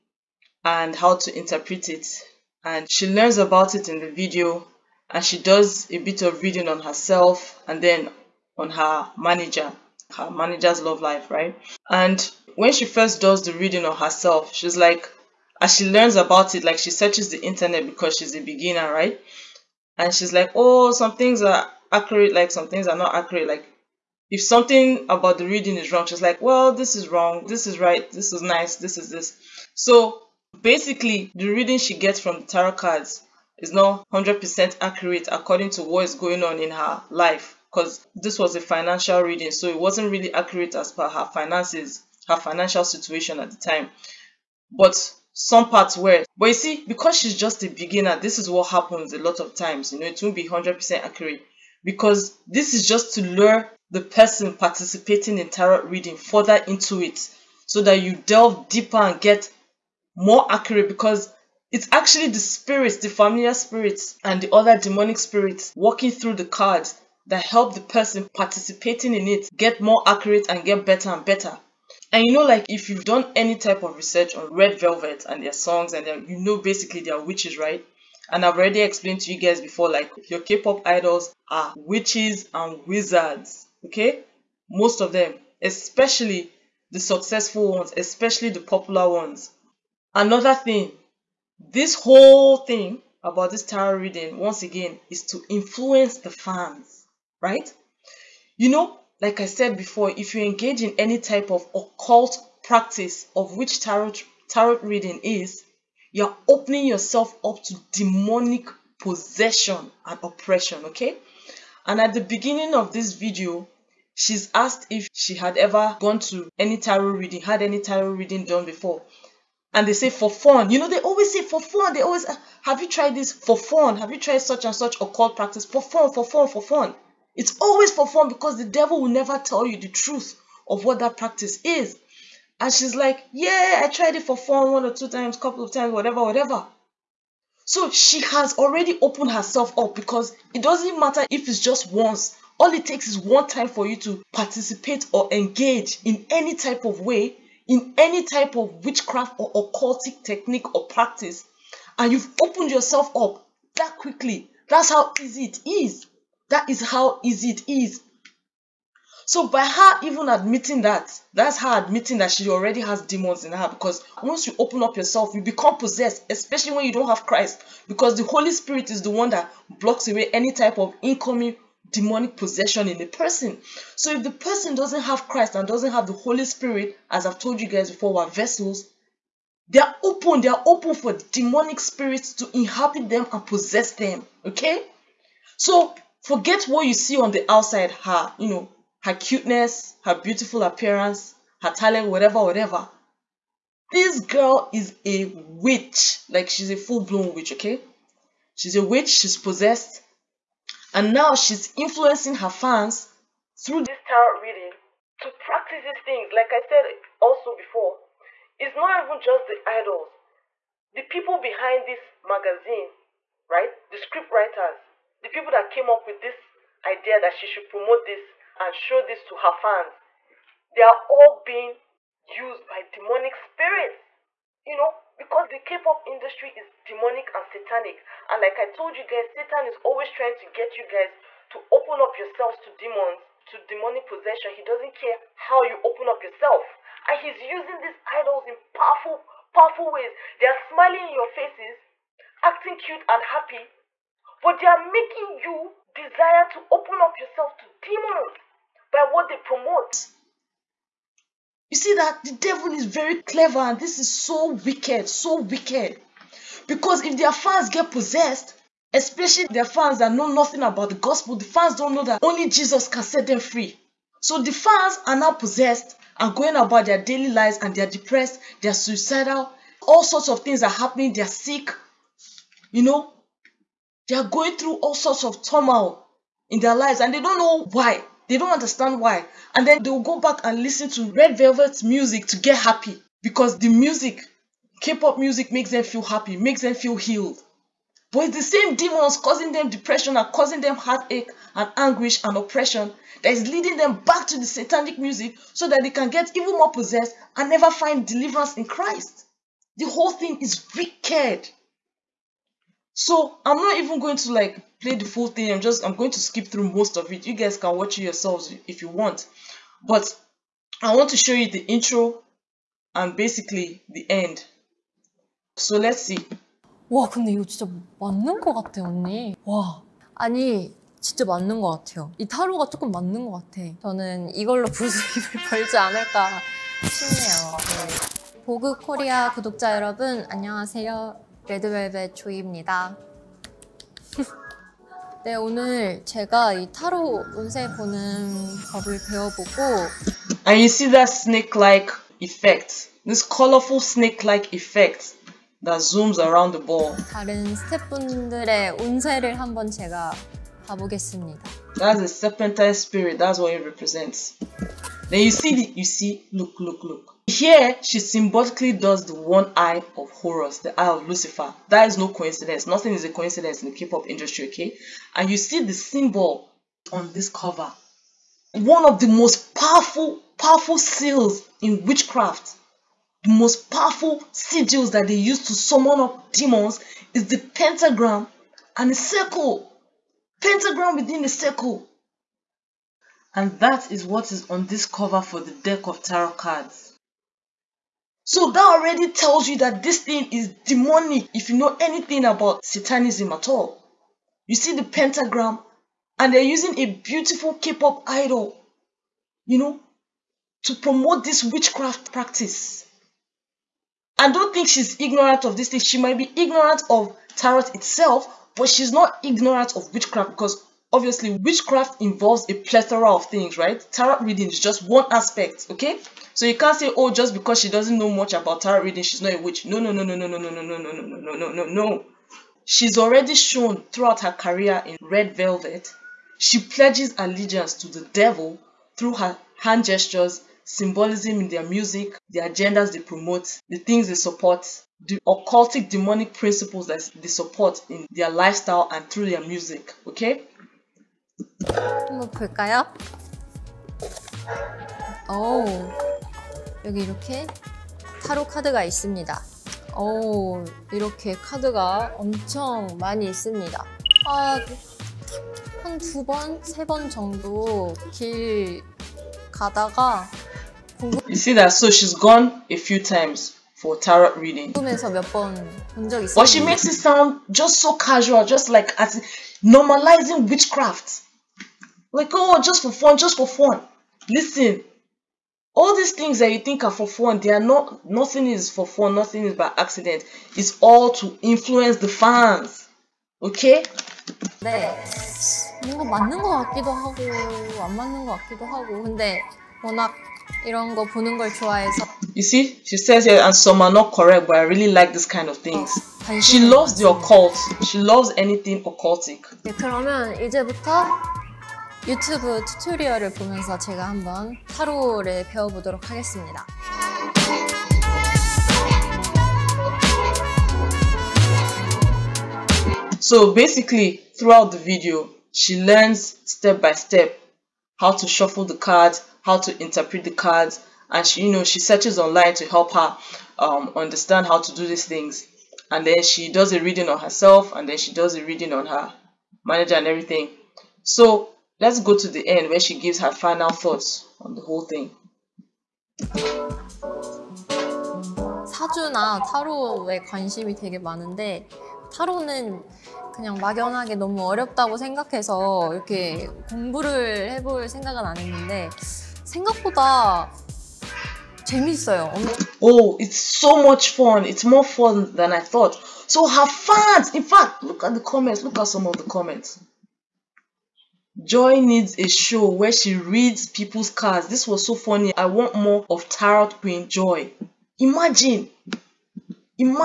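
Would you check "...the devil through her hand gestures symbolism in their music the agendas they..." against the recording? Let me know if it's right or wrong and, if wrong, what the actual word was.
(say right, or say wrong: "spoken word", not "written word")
right.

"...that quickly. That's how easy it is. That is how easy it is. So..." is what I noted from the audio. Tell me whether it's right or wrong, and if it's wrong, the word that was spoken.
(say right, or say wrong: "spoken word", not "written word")
right.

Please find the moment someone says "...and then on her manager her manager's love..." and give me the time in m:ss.
0:07.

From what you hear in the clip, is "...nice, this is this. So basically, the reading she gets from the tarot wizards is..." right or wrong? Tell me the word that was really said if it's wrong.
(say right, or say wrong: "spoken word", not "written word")
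wrong: "cards", not "wizards".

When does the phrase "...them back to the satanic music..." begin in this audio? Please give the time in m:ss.
4:53.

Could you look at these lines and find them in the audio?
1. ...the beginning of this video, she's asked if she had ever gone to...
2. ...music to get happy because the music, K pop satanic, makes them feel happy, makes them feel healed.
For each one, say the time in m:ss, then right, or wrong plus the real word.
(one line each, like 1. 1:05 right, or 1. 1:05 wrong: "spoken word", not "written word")
1. 1:52 right
2. 4:41 wrong: "music", not "satanic".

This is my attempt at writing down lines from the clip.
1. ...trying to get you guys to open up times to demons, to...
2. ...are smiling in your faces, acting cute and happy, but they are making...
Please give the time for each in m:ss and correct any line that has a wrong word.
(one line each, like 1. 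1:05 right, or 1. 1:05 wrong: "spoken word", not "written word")
1. 3:50 wrong: "yourselves", not "times"
2. 4:00 right.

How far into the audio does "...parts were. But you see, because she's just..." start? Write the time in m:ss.
0:45.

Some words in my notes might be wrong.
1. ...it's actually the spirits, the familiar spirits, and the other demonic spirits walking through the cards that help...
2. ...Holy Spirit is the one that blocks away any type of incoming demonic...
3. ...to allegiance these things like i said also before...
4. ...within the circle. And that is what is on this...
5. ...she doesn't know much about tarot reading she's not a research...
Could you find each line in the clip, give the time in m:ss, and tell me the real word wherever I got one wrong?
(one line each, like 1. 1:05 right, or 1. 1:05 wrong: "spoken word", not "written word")
1. 1:01 right
2. 2:48 right
3. 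3:25 wrong: "practice", not "allegiance"
4. 6:20 right
5. 6:57 wrong: "witch", not "research".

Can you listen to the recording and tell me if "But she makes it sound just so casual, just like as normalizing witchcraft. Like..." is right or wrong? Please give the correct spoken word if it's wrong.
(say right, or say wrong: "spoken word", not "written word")
right.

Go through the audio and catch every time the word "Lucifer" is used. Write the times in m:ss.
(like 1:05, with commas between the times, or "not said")
6:01.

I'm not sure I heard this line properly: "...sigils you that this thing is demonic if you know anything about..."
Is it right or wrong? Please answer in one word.
wrong.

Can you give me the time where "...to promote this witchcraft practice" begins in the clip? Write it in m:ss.
6:40.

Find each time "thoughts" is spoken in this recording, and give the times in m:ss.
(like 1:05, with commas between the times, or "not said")
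8:53, 9:15.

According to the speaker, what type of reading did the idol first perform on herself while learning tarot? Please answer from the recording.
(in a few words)
financial reading.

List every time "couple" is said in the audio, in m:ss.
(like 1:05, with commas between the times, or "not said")
2:15.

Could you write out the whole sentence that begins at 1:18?
And I've already explained to you guys before, like your K-pop idols are witches and wizards, okay?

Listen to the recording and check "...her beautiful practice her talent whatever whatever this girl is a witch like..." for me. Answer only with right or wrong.
wrong.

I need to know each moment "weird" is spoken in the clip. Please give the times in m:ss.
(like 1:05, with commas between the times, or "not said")
not said.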